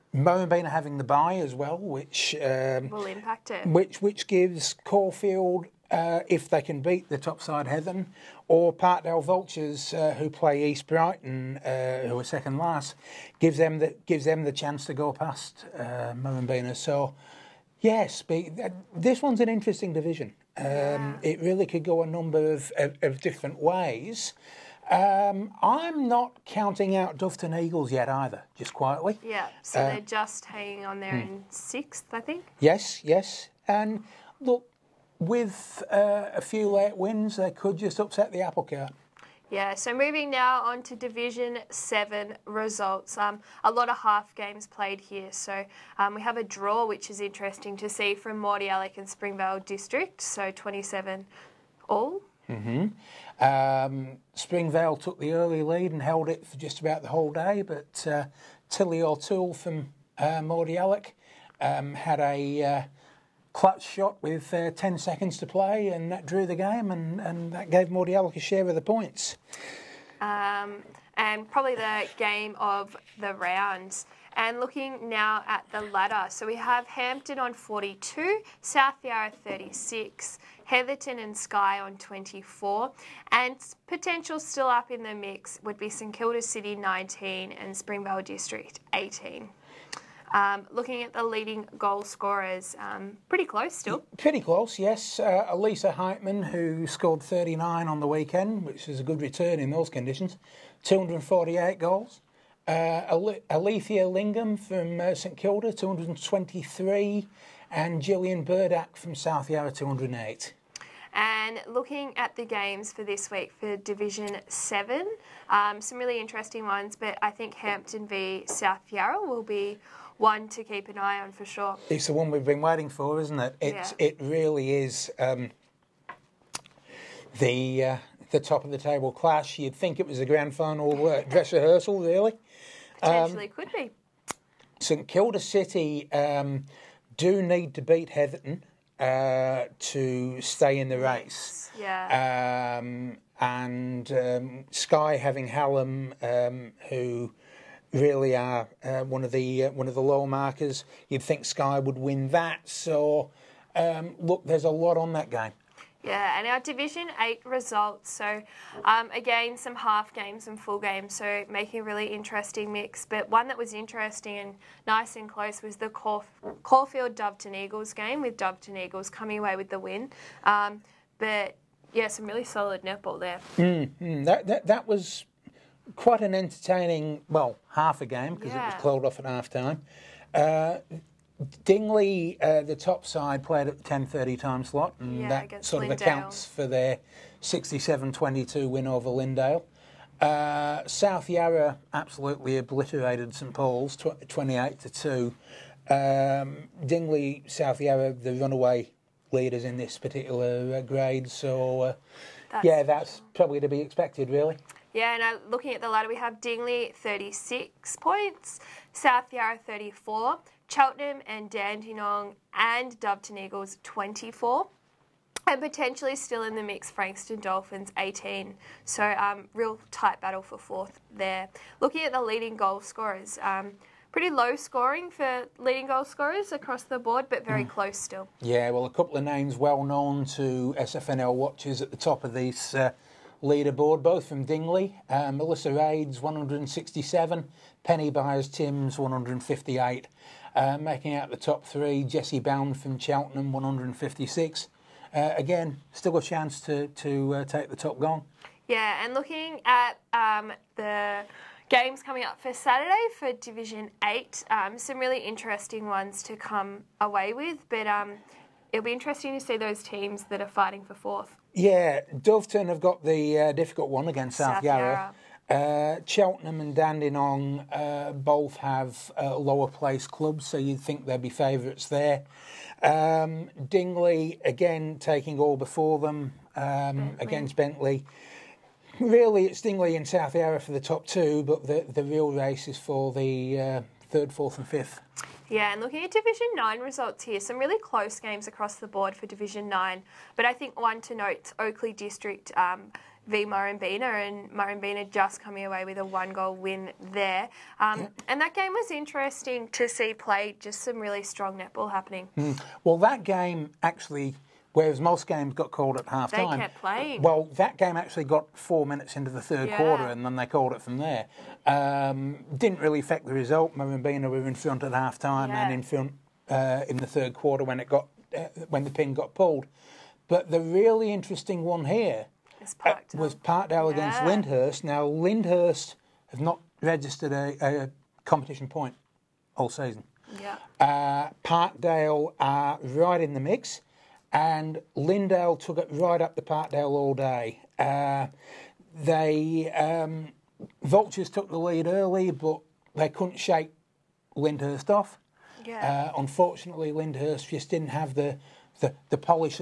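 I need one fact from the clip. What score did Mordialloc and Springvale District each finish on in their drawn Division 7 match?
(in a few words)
27.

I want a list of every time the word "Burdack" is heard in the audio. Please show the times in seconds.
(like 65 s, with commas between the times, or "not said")
108 s.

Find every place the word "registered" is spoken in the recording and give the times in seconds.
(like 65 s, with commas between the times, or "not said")
326 s.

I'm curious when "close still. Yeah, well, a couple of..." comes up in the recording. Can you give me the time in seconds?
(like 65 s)
227 s.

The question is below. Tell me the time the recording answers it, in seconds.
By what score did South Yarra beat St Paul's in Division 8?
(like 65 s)
194 s.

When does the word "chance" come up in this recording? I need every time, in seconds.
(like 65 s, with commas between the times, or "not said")
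14 s, 246 s.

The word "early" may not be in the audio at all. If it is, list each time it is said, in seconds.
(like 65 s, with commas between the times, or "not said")
55 s, 341 s.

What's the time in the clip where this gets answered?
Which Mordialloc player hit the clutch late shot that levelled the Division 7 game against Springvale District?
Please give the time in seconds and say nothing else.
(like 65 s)
58 s.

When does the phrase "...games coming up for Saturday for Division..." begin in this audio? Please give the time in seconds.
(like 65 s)
251 s.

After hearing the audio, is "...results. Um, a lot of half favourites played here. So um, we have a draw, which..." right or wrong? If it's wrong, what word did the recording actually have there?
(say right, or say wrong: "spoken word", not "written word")
wrong: "games", not "favourites".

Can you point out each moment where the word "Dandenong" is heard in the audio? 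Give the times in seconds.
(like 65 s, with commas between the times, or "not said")
211 s, 266 s.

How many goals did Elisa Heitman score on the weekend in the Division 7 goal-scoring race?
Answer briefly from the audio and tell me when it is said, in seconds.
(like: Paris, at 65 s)
39, at 97 s.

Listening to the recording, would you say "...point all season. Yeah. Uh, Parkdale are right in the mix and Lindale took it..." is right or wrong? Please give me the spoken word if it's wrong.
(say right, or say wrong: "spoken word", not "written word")
right.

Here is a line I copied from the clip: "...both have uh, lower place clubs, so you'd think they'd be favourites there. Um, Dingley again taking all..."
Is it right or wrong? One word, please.
right.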